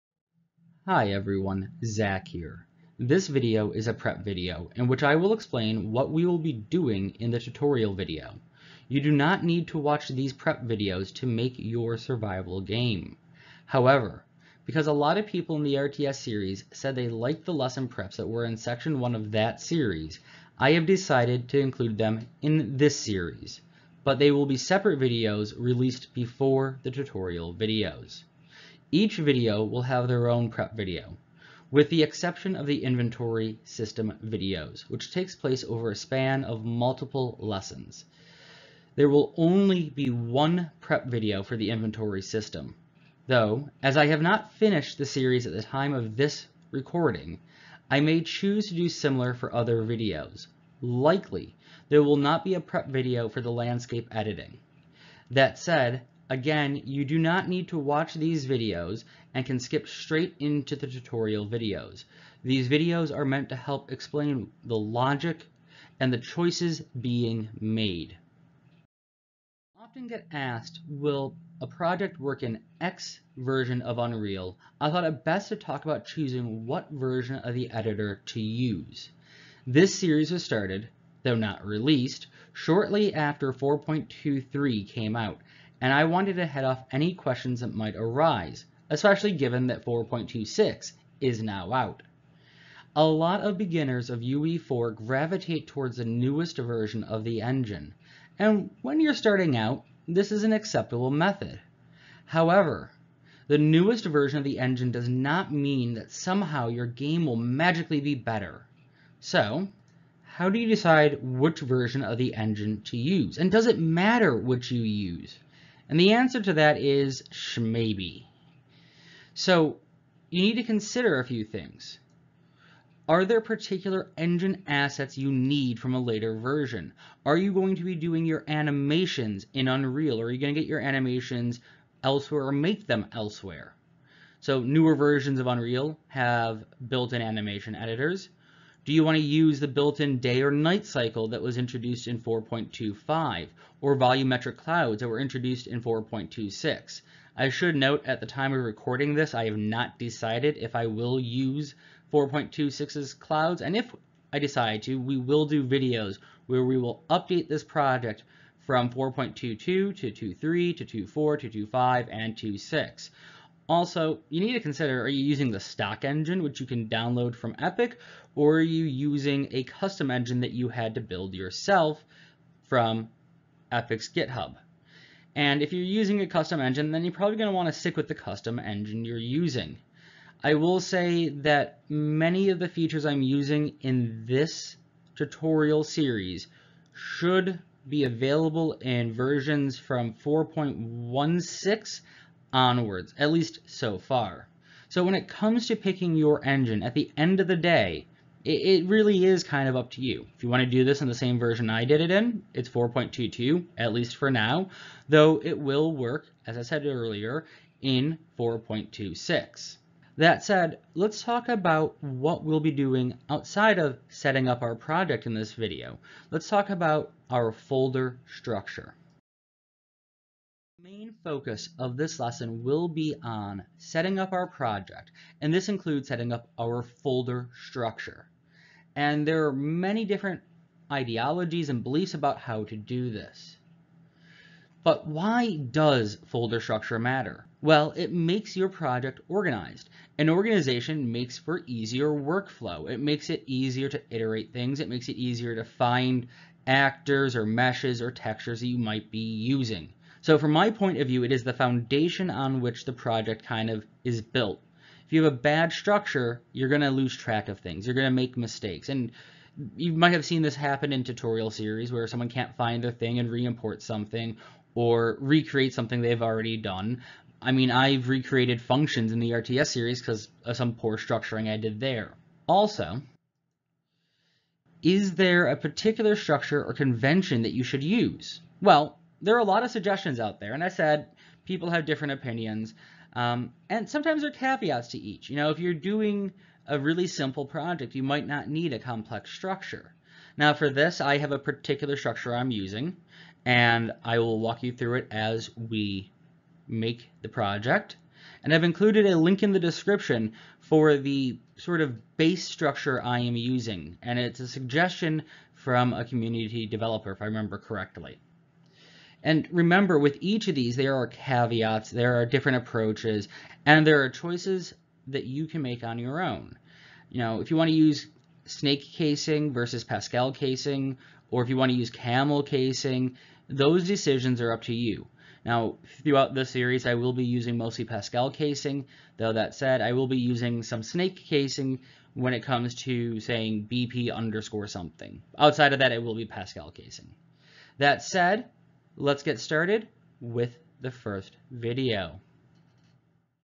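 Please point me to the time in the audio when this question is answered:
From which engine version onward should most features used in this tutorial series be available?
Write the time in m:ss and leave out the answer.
3:10.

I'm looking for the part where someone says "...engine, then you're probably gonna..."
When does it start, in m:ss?
2:56.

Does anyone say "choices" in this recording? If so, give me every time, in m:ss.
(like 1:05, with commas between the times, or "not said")
1:06, 5:14.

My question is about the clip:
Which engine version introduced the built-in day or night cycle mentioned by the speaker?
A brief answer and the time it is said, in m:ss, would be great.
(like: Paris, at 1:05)
4.25, at 2:22.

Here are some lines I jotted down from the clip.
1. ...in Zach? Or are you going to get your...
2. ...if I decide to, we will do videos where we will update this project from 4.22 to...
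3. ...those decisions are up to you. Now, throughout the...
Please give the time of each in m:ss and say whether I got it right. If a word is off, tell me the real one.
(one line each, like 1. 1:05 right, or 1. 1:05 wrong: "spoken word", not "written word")
1. 2:09 wrong: "Unreal", not "Zach"
2. 2:33 right
3. 5:23 right.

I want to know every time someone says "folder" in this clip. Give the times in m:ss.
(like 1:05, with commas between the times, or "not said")
3:37, 3:46, 3:56.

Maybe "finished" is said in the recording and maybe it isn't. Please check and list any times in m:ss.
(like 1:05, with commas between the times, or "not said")
0:44.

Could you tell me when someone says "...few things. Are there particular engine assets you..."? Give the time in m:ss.
2:01.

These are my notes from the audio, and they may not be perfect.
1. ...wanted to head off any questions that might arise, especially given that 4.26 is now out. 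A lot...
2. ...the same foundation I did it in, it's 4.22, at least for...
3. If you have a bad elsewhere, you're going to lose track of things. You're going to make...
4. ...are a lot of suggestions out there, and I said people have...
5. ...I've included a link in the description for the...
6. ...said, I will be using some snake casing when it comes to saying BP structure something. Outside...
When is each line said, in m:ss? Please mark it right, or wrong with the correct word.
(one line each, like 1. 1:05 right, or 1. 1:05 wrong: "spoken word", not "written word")
1. 1:26 right
2. 3:21 wrong: "version", not "foundation"
3. 4:15 wrong: "structure", not "elsewhere"
4. 4:39 right
5. 4:58 right
6. 5:29 wrong: "underscore", not "structure".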